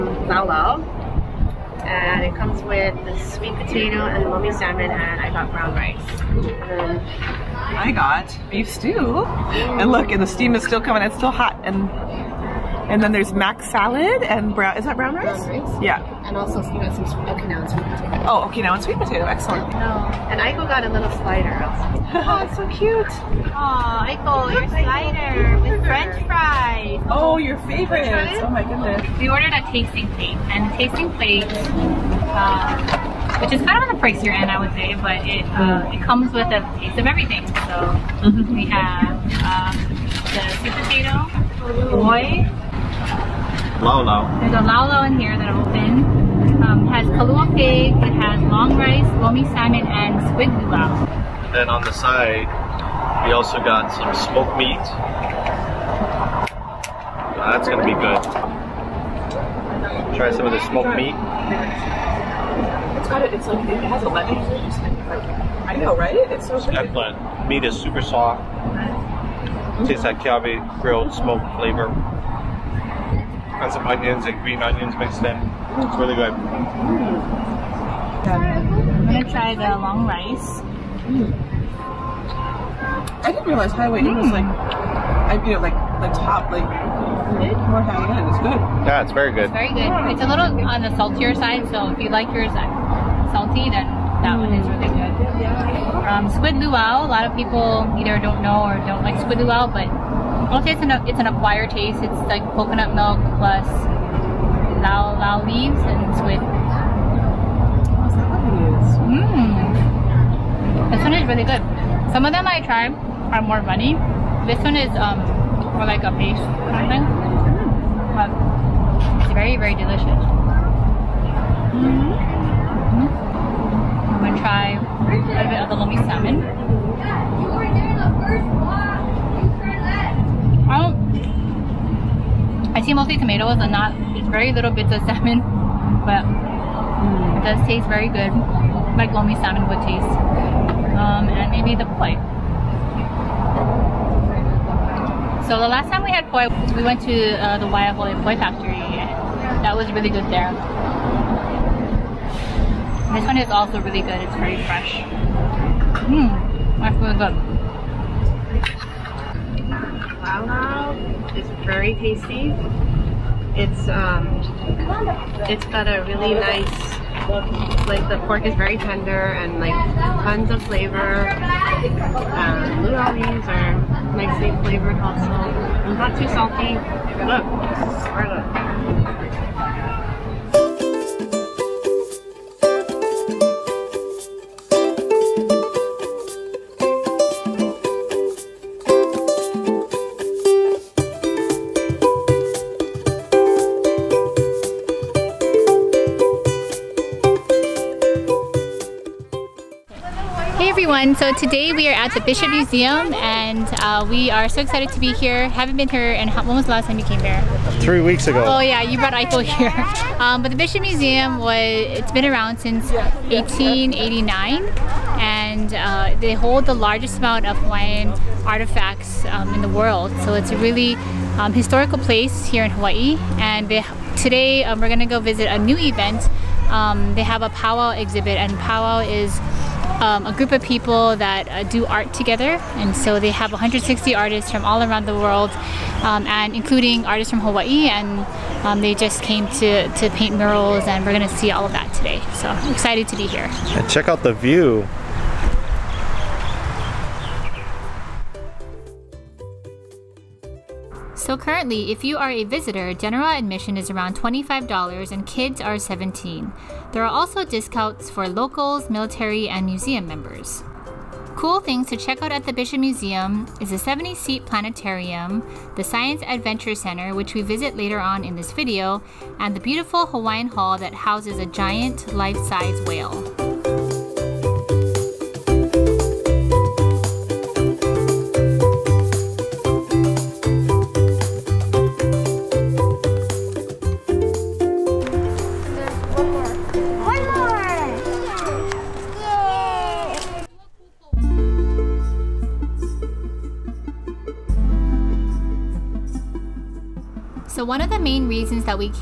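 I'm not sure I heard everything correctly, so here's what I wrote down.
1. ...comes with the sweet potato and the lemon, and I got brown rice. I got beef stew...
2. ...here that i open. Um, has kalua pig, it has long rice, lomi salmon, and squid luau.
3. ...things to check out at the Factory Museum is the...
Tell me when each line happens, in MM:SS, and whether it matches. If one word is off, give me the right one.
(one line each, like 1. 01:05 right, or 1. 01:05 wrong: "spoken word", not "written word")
1. 00:02 wrong: "salmon", not "lemon"
2. 00:45 right
3. 04:21 wrong: "Bishop", not "Factory".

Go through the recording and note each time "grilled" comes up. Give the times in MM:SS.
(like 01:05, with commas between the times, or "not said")
01:10.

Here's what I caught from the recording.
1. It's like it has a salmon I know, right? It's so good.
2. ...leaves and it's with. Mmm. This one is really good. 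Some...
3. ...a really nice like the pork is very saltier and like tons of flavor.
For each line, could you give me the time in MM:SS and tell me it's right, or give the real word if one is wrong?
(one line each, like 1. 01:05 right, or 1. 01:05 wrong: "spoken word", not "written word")
1. 01:03 wrong: "lemon", not "salmon"
2. 01:45 right
3. 02:45 wrong: "tender", not "saltier".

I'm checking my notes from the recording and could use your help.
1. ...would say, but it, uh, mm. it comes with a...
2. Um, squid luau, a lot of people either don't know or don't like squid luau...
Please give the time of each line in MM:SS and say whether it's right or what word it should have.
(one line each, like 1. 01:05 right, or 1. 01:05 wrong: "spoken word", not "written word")
1. 00:34 right
2. 01:36 right.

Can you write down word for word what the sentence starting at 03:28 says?
Oh yeah, you brought Eiffel here.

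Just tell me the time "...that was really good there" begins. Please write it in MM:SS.
02:29.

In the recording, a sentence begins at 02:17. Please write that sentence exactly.
it does taste very good, like lomi salmon would taste.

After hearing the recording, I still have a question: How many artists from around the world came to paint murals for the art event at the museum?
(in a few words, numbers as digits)
160.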